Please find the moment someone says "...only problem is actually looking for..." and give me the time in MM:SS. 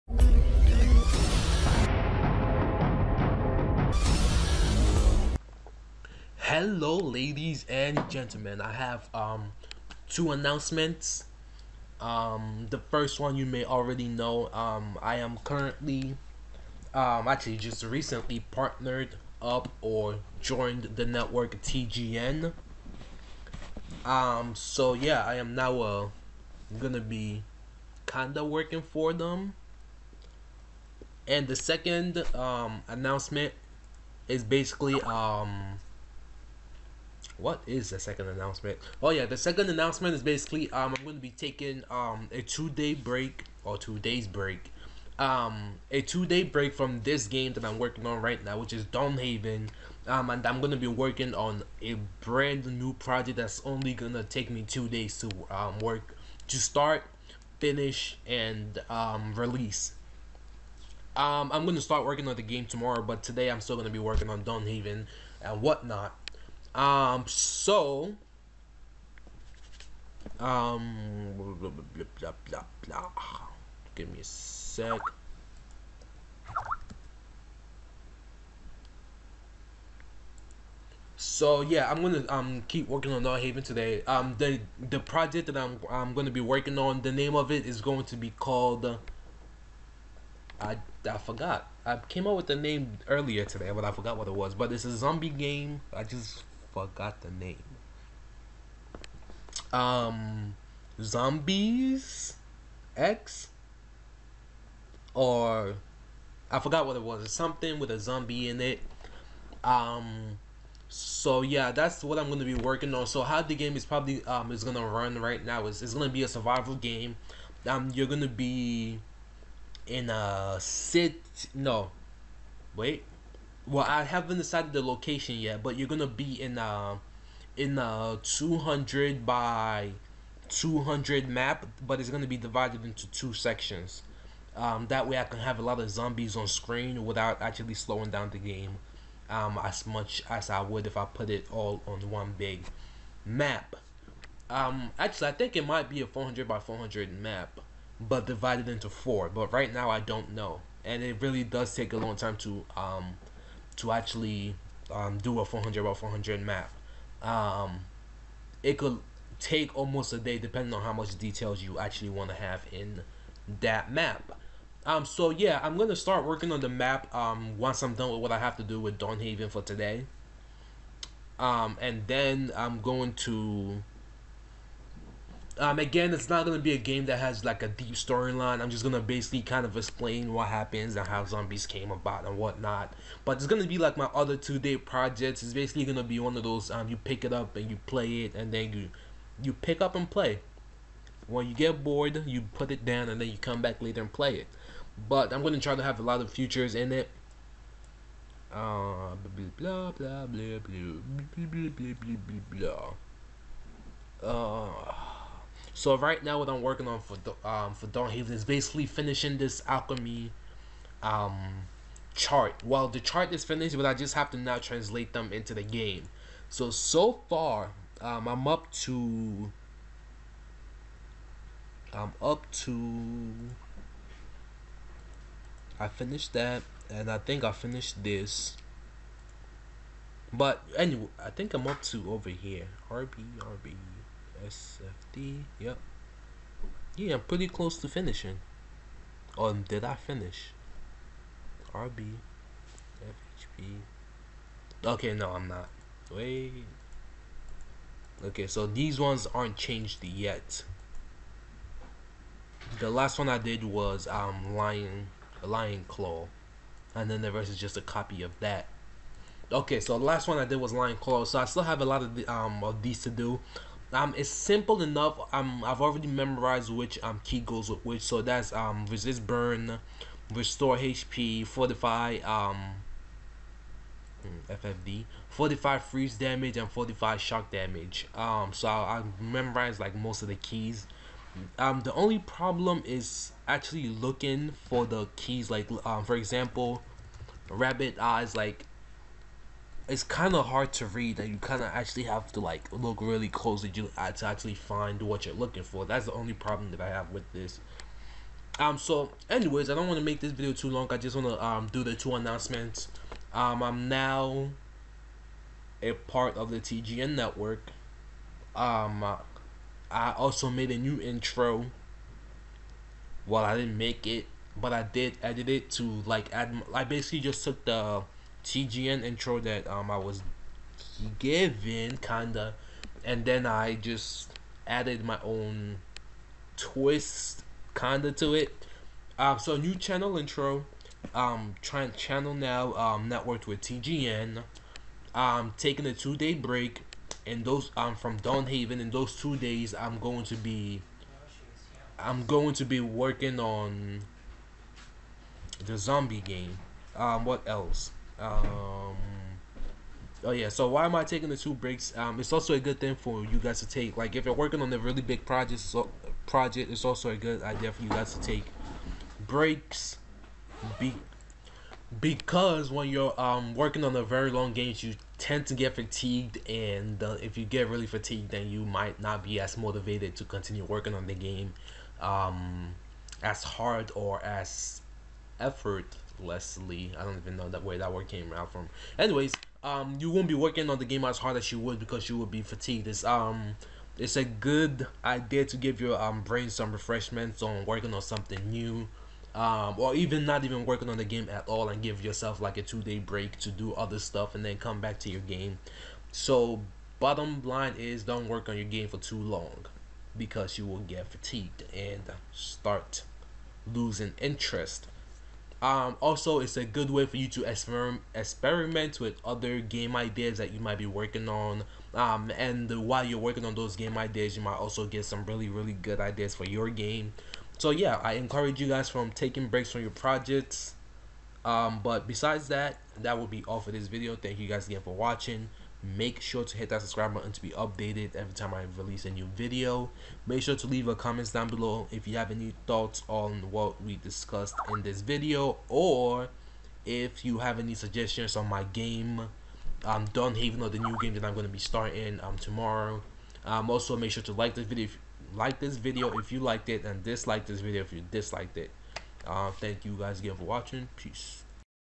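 04:41.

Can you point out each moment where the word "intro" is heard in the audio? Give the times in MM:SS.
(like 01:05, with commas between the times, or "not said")
05:11, 05:19, 05:30.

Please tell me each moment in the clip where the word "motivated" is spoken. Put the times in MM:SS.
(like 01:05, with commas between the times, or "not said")
06:09.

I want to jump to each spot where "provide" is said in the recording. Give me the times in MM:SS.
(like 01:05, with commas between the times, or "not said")
not said.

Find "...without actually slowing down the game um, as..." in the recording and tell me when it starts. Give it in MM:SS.
02:17.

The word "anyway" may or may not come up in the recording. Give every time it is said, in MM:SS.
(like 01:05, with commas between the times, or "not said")
03:50, 04:59, 06:18.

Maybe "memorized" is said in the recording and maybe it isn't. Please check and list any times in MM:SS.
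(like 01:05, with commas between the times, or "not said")
04:26, 04:39.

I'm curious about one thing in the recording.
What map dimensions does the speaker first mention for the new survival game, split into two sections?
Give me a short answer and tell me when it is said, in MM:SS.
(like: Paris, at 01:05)
200 by 200, at 02:08.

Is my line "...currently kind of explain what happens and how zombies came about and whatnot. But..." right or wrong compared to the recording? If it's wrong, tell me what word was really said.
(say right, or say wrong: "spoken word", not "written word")
wrong: "basically", not "currently".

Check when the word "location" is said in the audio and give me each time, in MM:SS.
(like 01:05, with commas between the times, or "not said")
02:04.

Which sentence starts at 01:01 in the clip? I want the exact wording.
Um, I'm gonna start working on the game tomorrow, but today I'm still gonna be working on Dawnhaven and whatnot.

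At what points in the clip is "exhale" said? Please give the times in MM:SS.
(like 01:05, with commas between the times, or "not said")
not said.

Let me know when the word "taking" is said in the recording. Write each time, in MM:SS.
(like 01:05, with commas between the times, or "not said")
00:41, 05:35, 05:51, 06:59.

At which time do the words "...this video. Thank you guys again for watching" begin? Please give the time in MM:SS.
07:03.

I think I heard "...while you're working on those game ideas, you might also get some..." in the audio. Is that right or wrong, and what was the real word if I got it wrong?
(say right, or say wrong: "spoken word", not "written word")
right.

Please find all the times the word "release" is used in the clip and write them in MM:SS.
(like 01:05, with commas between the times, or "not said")
00:59, 07:08.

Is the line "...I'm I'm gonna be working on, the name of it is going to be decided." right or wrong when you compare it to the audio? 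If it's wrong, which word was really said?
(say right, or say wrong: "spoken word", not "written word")
wrong: "called", not "decided".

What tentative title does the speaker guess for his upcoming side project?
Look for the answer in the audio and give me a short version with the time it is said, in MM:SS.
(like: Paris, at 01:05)
Zombies X, at 01:41.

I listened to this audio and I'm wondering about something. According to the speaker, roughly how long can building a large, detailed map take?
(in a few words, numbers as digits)
almost a day.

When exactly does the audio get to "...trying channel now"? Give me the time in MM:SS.
05:31.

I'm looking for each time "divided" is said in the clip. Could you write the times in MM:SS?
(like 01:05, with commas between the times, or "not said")
02:12, 02:28.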